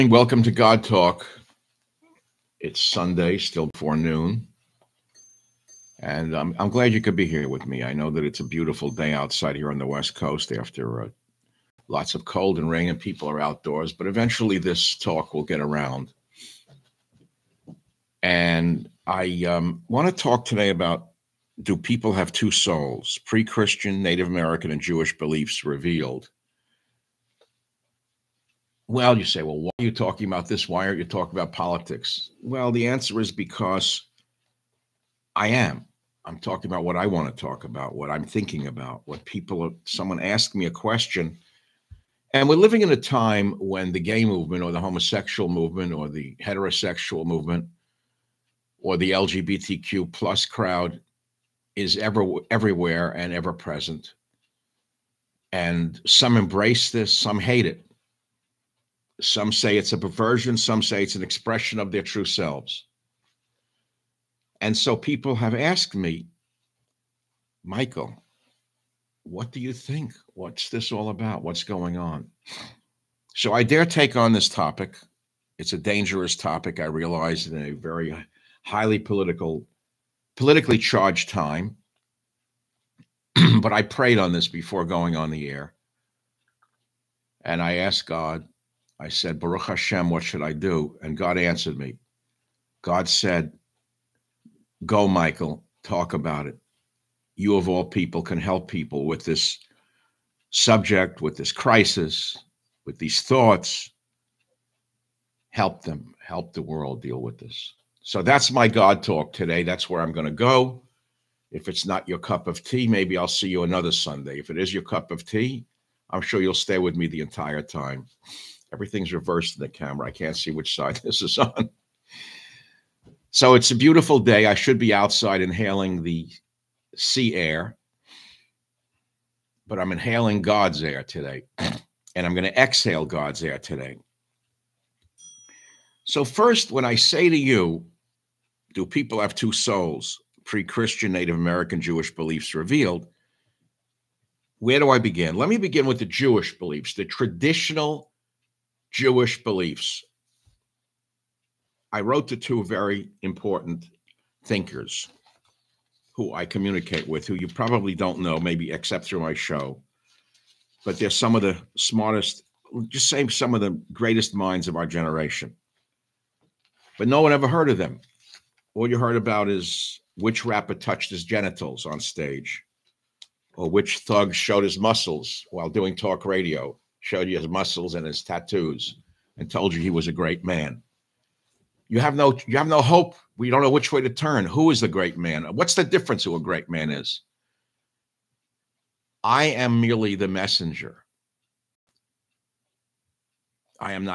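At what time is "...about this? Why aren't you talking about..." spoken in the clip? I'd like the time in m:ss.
0:30.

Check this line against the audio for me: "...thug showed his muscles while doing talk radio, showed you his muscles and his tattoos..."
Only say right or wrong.
right.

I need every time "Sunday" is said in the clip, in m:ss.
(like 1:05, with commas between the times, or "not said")
0:02, 1:53.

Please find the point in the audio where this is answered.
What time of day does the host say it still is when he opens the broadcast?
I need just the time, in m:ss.
0:03.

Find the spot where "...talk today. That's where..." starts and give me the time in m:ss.
1:49.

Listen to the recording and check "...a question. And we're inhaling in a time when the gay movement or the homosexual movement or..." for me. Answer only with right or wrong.
wrong.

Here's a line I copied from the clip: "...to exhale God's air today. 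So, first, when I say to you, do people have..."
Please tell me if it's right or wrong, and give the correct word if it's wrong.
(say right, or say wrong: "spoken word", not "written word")
right.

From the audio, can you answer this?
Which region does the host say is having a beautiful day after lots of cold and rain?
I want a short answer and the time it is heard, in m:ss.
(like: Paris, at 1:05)
West Coast, at 0:09.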